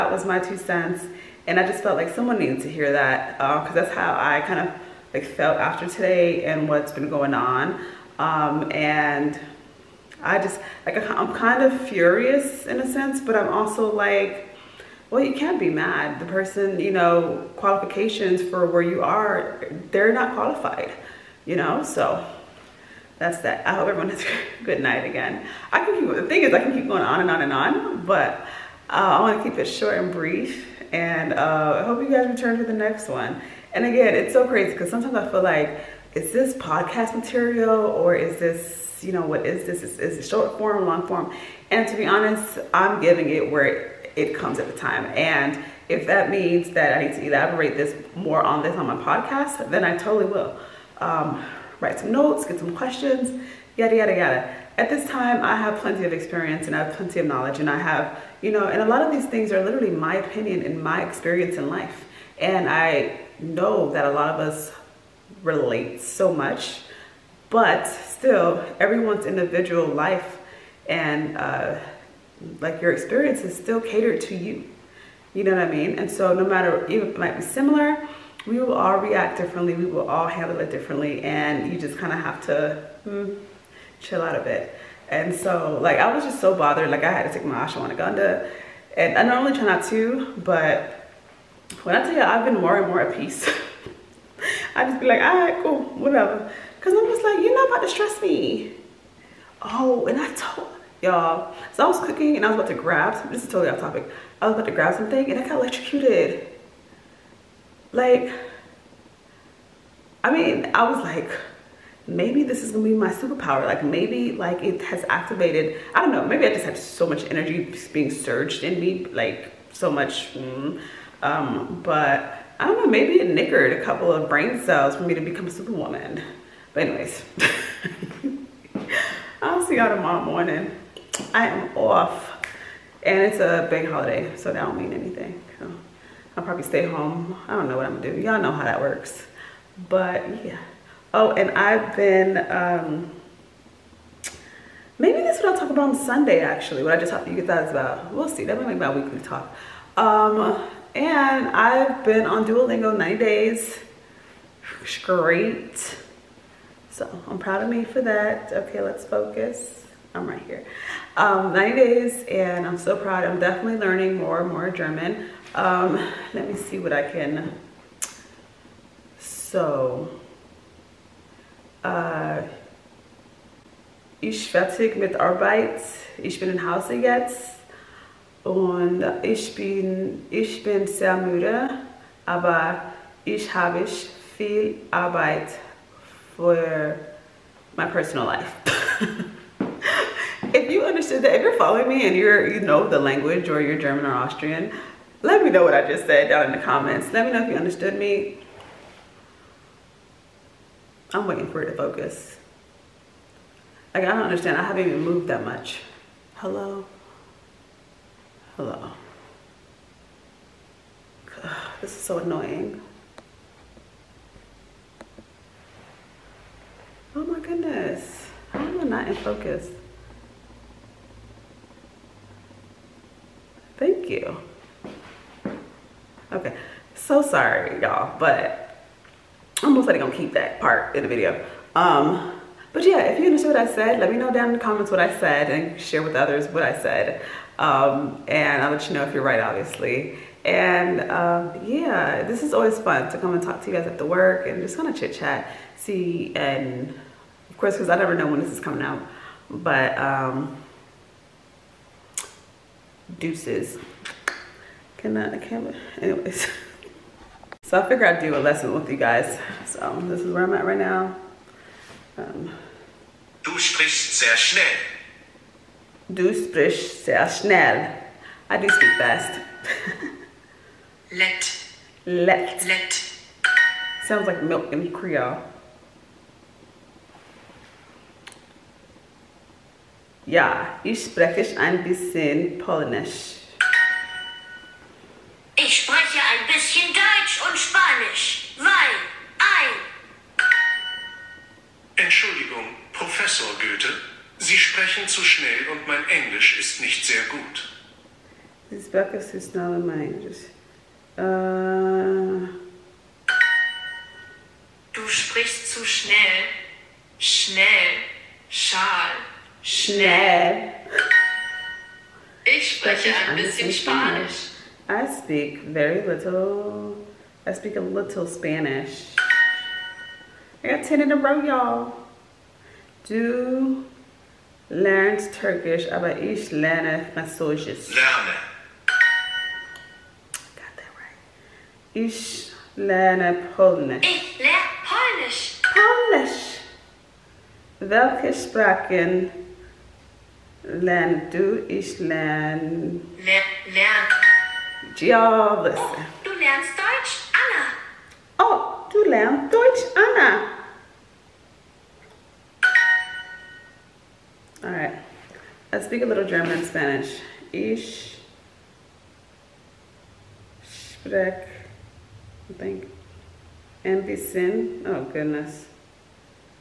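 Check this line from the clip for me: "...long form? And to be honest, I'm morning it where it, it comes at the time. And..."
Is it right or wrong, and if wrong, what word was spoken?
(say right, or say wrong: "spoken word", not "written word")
wrong: "giving", not "morning".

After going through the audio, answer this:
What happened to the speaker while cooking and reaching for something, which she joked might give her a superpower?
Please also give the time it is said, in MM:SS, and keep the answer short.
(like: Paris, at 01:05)
got electrocuted, at 01:45.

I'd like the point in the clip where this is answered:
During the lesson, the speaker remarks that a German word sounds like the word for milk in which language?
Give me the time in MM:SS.
04:34.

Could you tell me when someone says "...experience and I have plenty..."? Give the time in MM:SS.
00:56.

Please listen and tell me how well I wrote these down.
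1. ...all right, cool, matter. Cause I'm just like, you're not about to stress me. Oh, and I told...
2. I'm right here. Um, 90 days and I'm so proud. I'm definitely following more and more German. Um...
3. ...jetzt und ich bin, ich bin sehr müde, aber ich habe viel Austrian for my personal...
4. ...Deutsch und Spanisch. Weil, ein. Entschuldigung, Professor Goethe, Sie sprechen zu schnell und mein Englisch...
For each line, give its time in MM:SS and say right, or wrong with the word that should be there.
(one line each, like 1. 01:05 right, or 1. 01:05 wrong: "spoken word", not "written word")
1. 01:35 wrong: "whatever", not "matter"
2. 02:40 wrong: "learning", not "following"
3. 02:56 wrong: "Arbeit", not "Austrian"
4. 04:46 right.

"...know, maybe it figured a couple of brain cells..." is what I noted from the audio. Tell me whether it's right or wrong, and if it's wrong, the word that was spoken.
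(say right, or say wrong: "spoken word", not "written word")
wrong: "nickered", not "figured".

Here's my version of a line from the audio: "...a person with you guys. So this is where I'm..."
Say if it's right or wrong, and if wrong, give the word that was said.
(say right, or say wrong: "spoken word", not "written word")
wrong: "lesson", not "person".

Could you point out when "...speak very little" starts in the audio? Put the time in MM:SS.
05:15.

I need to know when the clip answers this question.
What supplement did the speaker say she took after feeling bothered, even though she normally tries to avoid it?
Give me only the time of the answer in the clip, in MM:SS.
01:27.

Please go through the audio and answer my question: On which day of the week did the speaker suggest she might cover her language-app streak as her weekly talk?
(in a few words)
Sunday.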